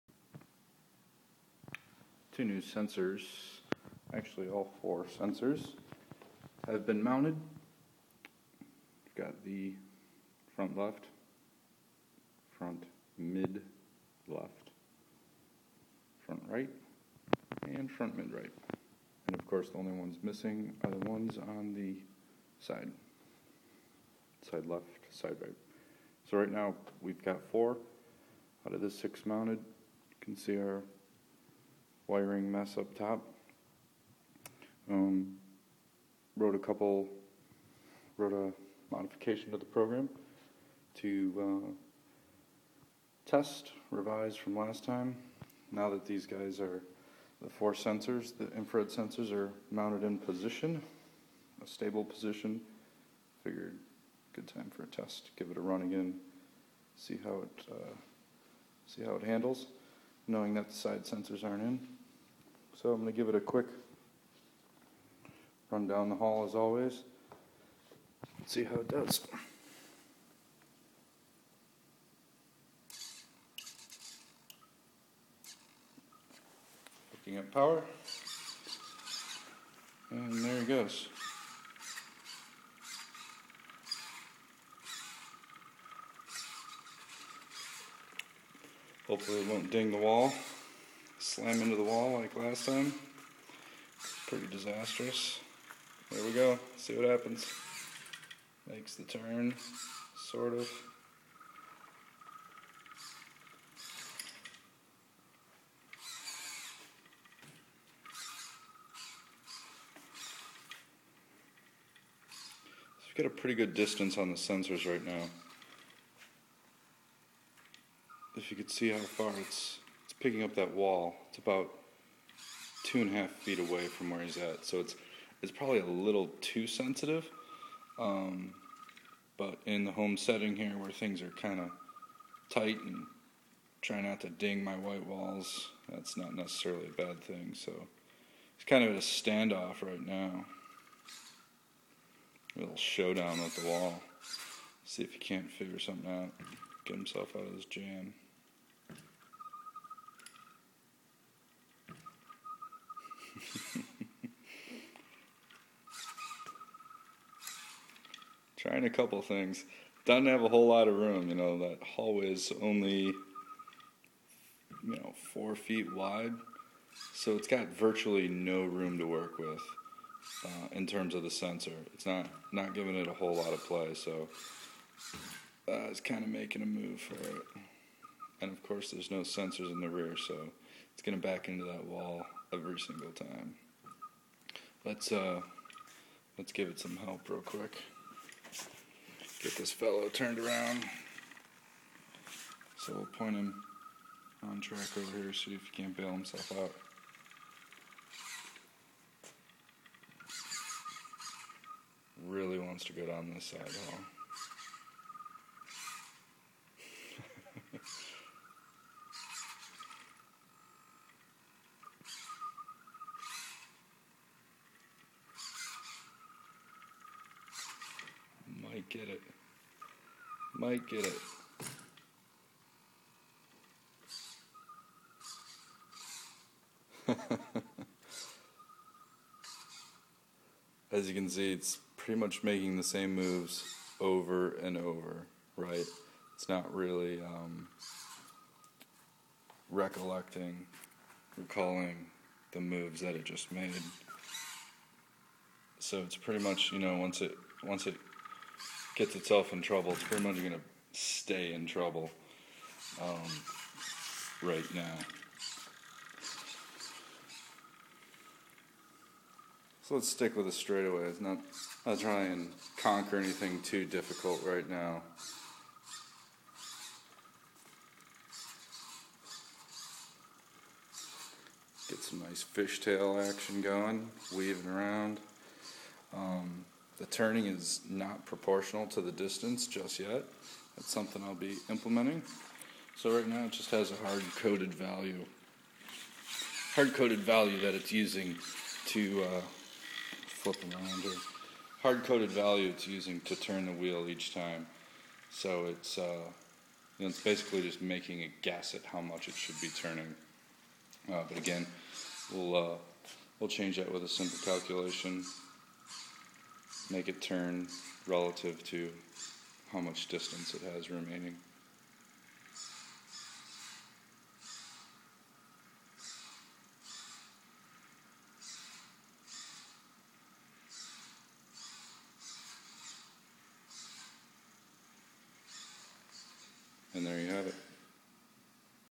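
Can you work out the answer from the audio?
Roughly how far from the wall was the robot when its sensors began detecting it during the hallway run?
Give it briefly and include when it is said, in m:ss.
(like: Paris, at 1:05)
2.5 feet, at 2:02.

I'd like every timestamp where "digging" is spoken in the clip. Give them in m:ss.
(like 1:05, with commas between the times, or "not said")
not said.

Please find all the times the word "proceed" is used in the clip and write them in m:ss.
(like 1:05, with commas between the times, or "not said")
not said.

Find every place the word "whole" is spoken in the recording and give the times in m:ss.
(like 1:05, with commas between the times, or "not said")
2:40, 2:53.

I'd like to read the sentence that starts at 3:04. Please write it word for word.
Let's uh, let's give it some help real quick.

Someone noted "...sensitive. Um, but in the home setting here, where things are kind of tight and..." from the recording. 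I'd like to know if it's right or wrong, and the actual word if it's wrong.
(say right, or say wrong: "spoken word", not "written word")
right.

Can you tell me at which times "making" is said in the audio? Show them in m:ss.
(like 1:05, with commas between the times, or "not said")
2:56, 3:52, 4:57.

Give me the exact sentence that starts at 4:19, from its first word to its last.
So let's stick with the It's Not, not try and conquer anything too difficult right now.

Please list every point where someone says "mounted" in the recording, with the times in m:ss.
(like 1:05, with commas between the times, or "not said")
0:07, 0:29, 0:49.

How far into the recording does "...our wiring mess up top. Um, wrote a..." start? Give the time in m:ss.
0:30.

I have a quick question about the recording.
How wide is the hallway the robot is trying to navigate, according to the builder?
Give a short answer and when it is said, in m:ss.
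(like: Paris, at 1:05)
4 feet, at 2:45.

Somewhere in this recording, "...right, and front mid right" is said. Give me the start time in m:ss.
0:16.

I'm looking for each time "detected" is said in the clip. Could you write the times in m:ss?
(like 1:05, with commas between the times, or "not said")
not said.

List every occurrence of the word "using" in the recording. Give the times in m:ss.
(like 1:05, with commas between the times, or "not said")
4:47, 4:52.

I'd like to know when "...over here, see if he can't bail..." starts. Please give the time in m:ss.
3:14.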